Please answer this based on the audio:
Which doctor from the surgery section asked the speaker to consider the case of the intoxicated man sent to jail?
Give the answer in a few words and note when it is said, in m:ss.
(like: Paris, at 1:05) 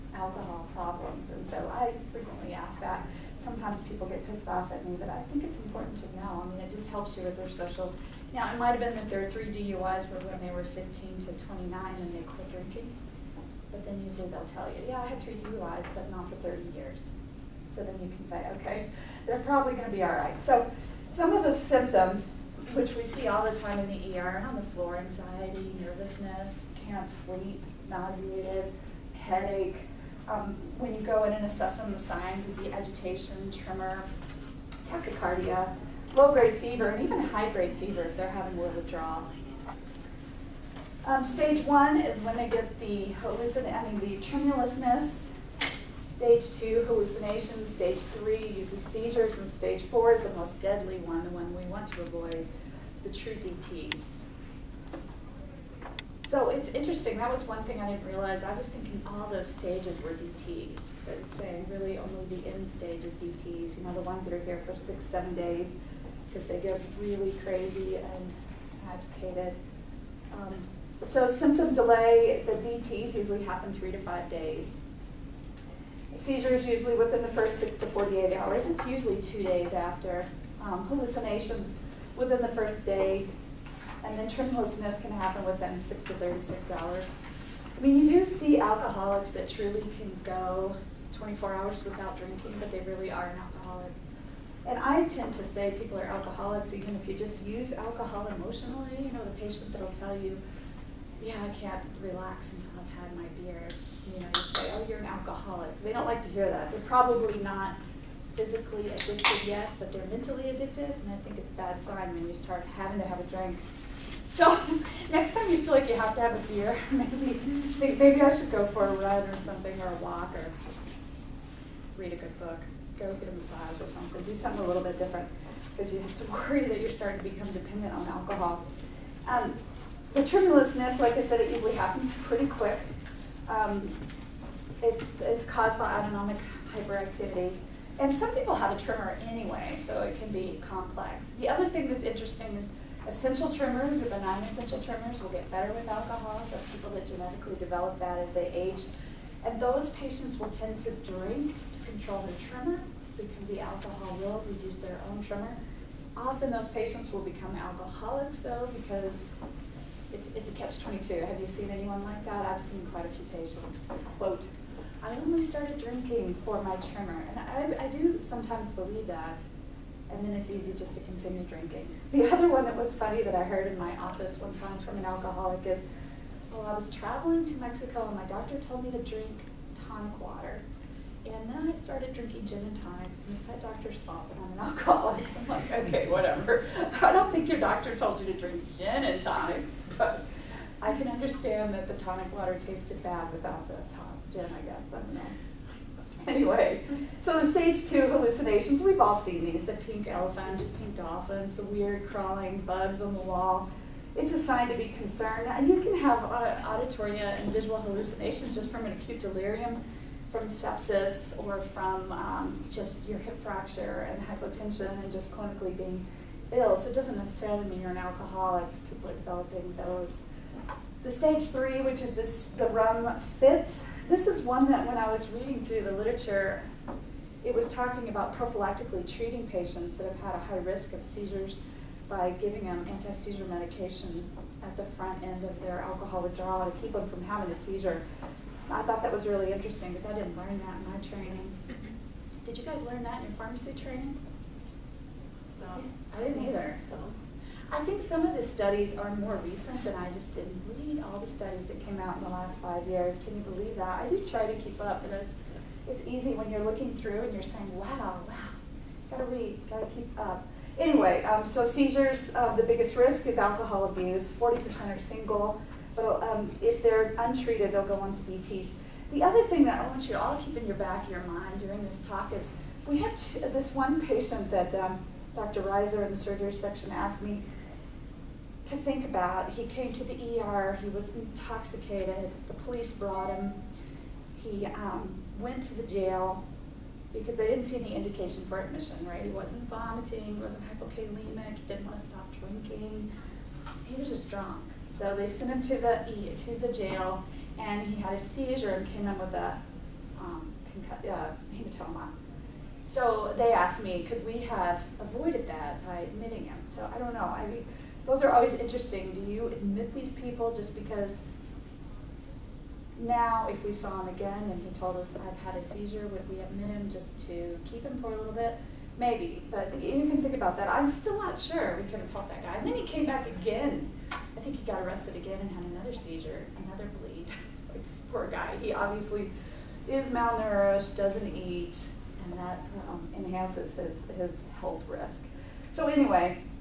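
Dr. Reiser, at 4:35.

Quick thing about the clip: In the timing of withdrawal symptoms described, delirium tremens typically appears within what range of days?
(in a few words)
3 to 5 days.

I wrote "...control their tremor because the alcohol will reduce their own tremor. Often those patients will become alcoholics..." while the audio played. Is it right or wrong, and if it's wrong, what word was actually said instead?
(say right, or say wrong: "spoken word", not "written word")
right.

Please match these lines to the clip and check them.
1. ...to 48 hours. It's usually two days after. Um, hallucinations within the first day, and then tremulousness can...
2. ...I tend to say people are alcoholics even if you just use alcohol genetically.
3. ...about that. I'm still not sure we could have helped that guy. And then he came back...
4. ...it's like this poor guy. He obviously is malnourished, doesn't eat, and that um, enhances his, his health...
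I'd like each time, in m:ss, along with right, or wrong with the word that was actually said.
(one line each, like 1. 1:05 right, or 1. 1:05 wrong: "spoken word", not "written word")
1. 1:17 right
2. 1:34 wrong: "emotionally", not "genetically"
3. 5:20 right
4. 5:27 right.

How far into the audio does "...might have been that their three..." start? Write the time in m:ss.
0:08.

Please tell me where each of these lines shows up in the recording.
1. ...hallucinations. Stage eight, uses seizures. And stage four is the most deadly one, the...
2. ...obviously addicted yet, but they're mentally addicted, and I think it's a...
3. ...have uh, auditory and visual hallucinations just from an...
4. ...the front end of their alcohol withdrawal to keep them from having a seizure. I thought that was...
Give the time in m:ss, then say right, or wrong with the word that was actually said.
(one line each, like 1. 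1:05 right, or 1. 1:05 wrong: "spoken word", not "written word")
1. 0:46 wrong: "three", not "eight"
2. 1:48 wrong: "physically", not "obviously"
3. 3:25 right
4. 3:54 right.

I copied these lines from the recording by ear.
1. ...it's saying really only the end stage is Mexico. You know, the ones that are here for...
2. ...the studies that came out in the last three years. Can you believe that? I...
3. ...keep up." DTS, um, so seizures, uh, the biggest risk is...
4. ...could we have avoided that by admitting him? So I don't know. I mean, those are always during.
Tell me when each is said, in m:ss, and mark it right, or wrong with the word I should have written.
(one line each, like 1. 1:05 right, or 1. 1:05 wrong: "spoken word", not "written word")
1. 1:01 wrong: "DTs", not "Mexico"
2. 4:11 wrong: "five", not "three"
3. 4:19 wrong: "Anyway", not "DTS"
4. 5:04 wrong: "interesting", not "during".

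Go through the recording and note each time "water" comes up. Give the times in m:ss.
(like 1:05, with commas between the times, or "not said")
3:00, 3:12.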